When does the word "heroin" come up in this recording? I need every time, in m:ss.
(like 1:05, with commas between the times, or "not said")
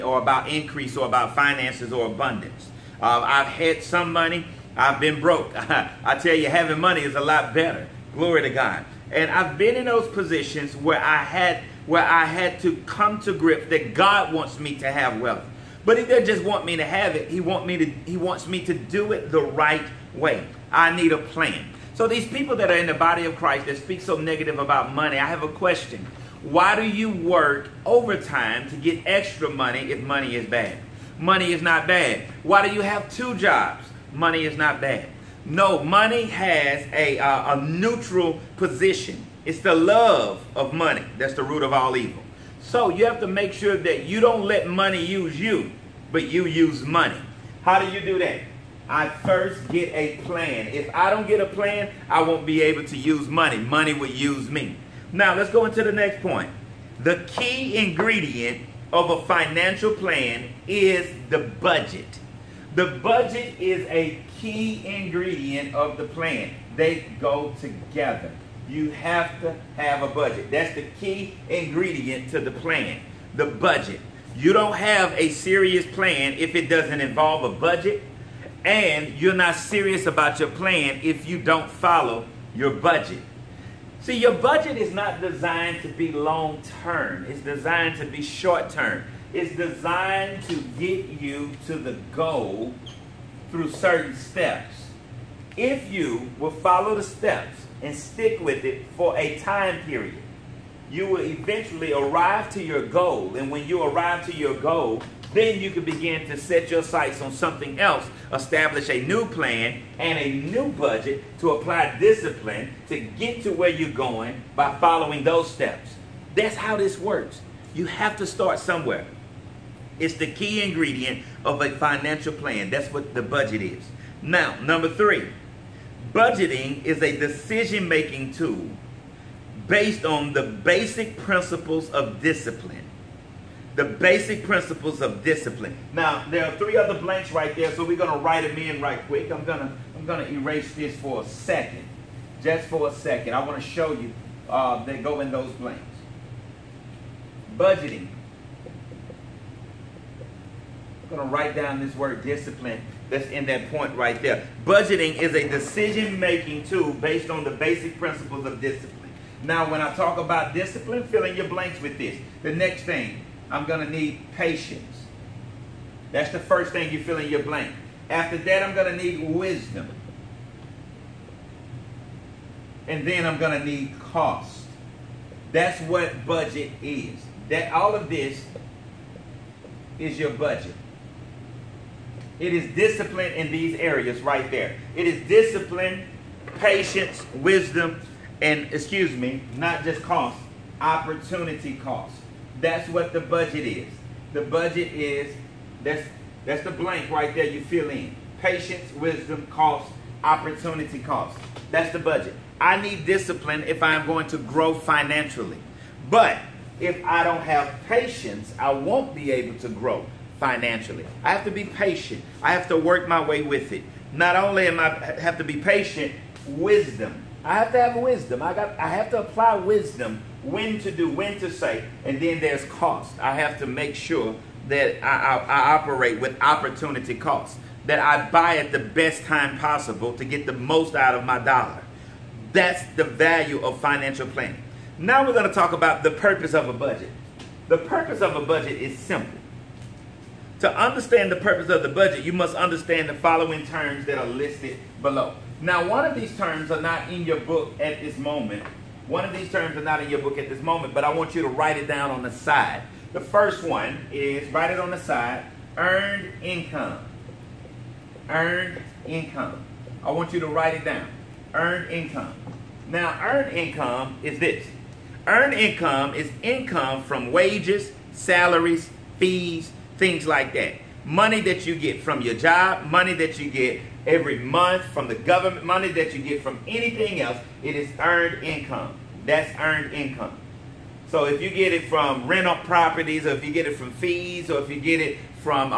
not said.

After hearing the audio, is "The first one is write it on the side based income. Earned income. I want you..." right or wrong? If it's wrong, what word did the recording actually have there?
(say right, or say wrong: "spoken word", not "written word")
wrong: "earned", not "based".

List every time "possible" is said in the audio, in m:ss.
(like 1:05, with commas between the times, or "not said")
3:49.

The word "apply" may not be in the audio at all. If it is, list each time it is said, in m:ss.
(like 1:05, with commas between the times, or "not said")
1:51, 3:39.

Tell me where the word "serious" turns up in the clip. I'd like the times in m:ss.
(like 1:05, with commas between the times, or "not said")
1:15, 1:19.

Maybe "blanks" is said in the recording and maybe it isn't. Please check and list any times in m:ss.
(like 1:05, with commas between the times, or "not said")
2:16, 2:25, 2:41, 2:47, 3:16.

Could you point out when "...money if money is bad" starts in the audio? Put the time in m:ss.
0:29.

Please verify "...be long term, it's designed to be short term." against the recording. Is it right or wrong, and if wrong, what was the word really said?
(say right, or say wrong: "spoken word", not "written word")
right.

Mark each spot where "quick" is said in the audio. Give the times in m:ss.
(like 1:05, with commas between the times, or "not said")
2:19.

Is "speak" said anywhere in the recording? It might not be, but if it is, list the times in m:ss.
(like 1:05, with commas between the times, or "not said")
0:23.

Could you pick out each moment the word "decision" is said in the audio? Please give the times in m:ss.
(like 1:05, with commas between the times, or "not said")
2:07, 2:35.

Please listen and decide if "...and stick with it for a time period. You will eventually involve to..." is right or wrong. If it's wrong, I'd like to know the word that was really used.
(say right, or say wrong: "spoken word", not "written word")
wrong: "arrive", not "involve".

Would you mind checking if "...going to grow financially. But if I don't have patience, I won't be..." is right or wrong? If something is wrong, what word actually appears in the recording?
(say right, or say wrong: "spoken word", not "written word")
right.